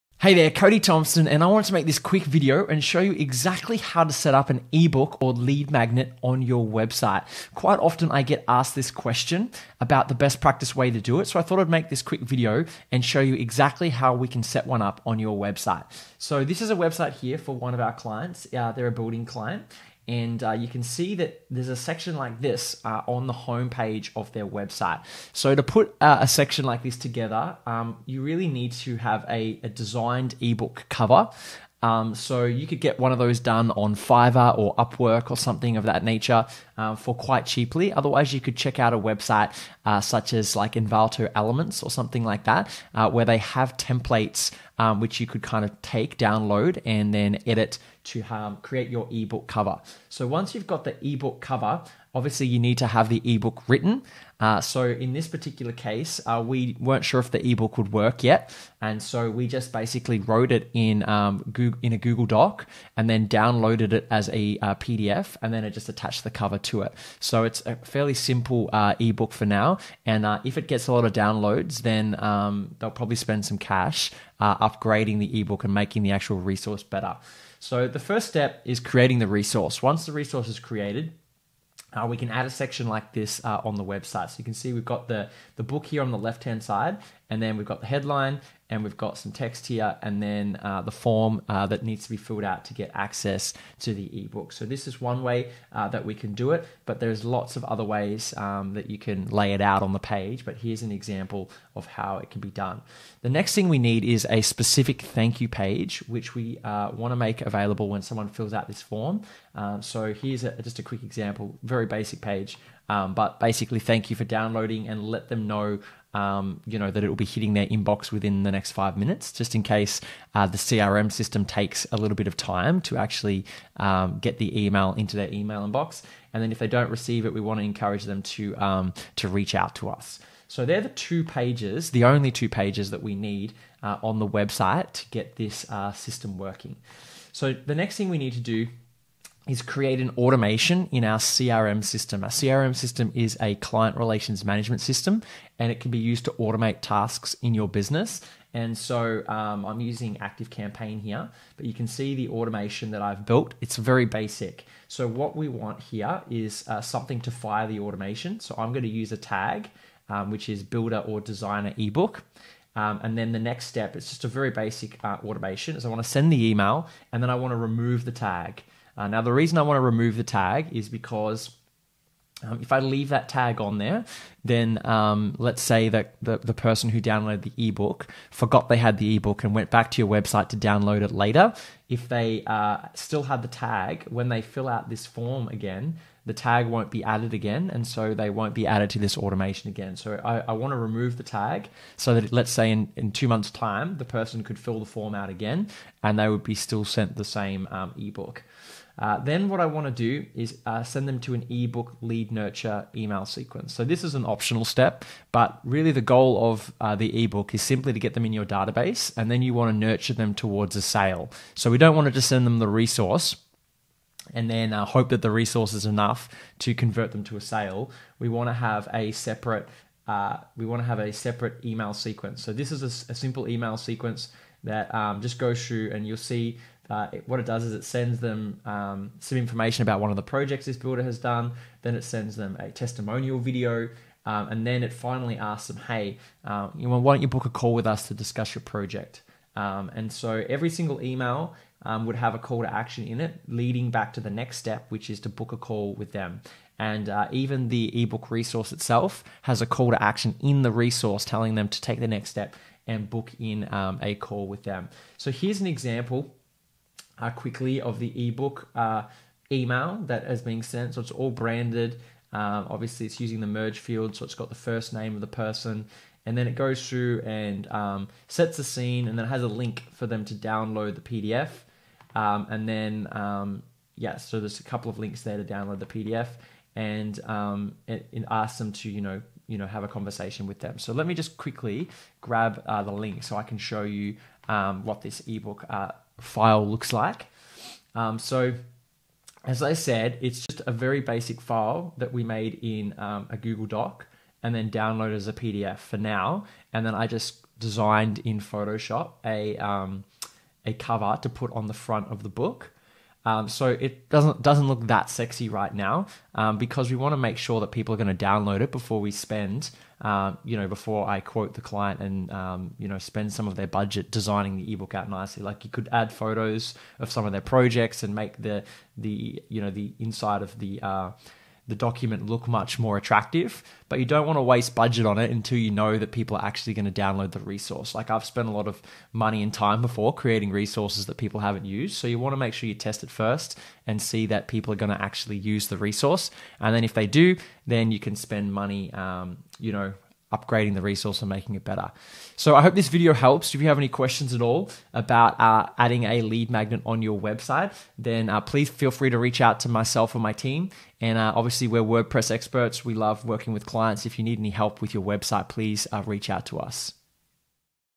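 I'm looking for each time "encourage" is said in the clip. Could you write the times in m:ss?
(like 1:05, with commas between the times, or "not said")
2:07.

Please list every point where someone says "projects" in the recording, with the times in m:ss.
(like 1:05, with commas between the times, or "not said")
3:50, 3:58, 5:17.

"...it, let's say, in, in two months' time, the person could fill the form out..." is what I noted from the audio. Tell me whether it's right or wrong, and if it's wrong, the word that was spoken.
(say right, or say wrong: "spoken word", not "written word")
right.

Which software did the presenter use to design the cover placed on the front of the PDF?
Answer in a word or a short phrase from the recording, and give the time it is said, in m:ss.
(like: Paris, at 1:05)
Photoshop, at 4:58.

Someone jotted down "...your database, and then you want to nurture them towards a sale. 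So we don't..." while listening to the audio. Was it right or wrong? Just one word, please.
right.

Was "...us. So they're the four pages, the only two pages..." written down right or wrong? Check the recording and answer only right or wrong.
wrong.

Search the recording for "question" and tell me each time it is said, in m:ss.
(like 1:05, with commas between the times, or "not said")
0:08, 5:43.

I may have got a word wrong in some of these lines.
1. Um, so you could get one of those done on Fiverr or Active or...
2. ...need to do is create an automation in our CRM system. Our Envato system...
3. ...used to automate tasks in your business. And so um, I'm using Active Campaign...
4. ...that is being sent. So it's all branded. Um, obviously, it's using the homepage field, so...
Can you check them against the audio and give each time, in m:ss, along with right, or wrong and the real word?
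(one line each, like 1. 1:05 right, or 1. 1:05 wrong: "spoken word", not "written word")
1. 0:31 wrong: "Upwork", not "Active"
2. 2:18 wrong: "CRM", not "Envato"
3. 2:25 right
4. 4:20 wrong: "merge", not "homepage".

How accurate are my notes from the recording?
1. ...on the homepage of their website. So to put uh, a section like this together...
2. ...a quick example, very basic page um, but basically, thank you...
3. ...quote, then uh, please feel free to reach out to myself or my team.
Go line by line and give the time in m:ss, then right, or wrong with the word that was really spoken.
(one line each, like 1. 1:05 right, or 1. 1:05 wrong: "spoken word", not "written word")
1. 0:23 right
2. 1:50 right
3. 5:47 wrong: "website", not "quote".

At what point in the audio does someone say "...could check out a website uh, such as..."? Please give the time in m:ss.
0:38.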